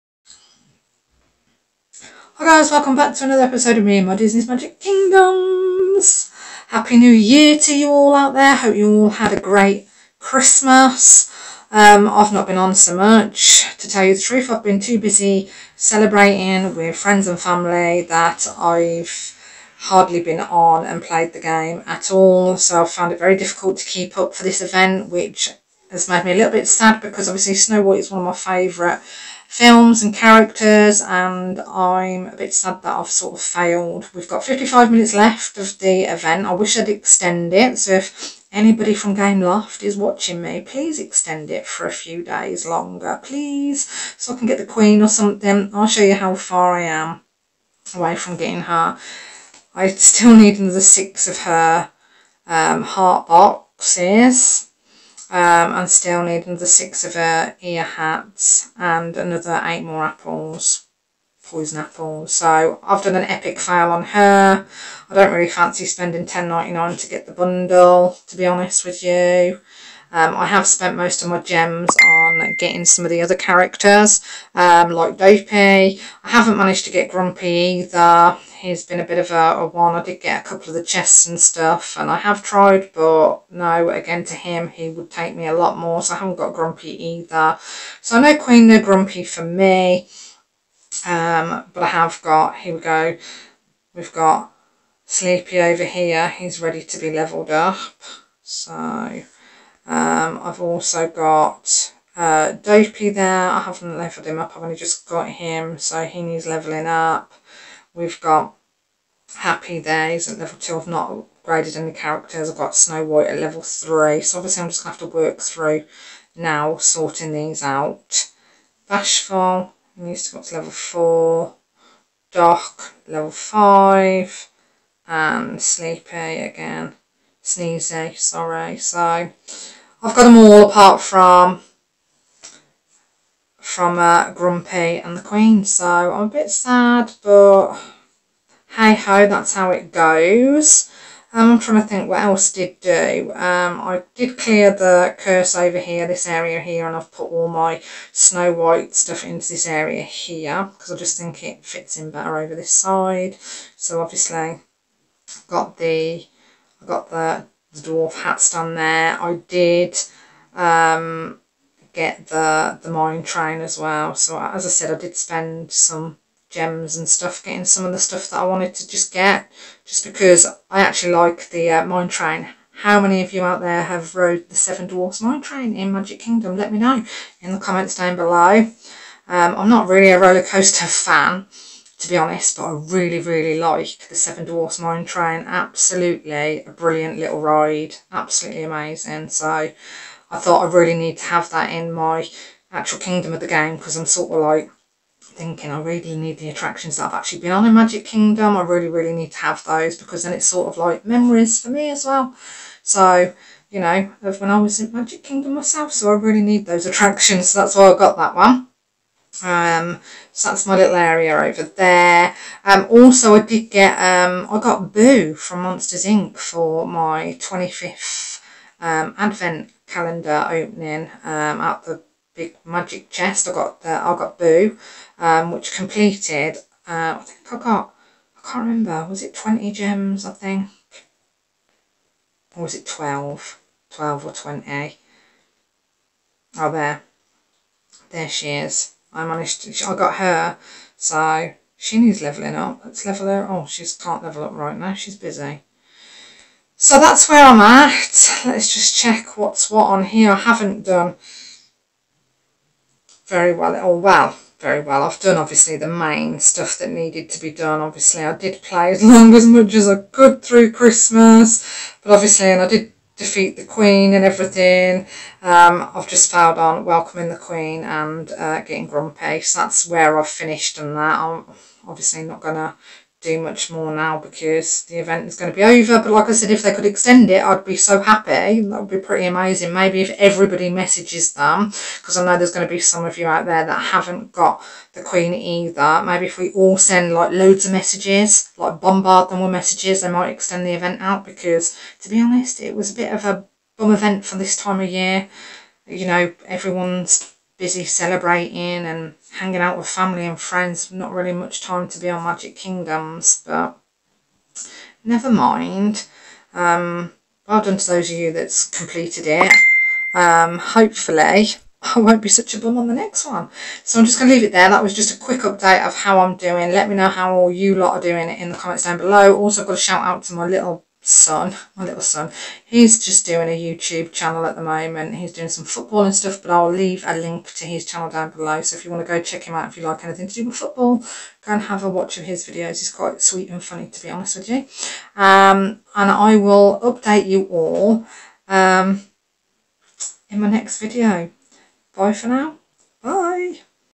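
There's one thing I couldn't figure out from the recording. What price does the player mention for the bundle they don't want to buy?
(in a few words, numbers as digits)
10.99.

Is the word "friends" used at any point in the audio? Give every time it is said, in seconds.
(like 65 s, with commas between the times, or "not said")
16 s, 300 s.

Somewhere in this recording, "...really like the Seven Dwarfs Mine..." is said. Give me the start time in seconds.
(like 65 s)
183 s.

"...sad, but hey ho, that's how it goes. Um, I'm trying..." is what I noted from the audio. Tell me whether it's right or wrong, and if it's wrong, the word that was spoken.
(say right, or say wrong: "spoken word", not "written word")
right.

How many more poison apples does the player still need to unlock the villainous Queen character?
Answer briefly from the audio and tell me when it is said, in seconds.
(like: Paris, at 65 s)
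8, at 59 s.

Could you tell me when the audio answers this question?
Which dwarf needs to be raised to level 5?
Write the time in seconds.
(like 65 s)
122 s.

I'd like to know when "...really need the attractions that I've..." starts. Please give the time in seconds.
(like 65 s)
195 s.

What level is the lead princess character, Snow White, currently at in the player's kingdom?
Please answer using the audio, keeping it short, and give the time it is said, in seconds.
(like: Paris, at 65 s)
level 3, at 113 s.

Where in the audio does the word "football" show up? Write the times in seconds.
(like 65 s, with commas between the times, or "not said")
325 s, 330 s.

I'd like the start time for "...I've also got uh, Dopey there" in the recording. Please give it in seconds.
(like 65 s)
100 s.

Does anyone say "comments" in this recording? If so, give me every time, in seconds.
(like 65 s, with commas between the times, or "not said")
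177 s, 318 s.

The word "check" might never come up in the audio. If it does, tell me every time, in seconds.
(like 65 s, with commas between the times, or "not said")
248 s, 329 s.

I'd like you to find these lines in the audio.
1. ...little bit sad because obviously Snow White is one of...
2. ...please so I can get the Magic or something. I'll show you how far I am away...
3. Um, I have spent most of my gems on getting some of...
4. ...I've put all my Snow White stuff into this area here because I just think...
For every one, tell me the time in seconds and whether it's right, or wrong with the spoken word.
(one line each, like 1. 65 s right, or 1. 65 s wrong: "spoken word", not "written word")
1. 26 s right
2. 43 s wrong: "Queen", not "Magic"
3. 70 s right
4. 146 s right.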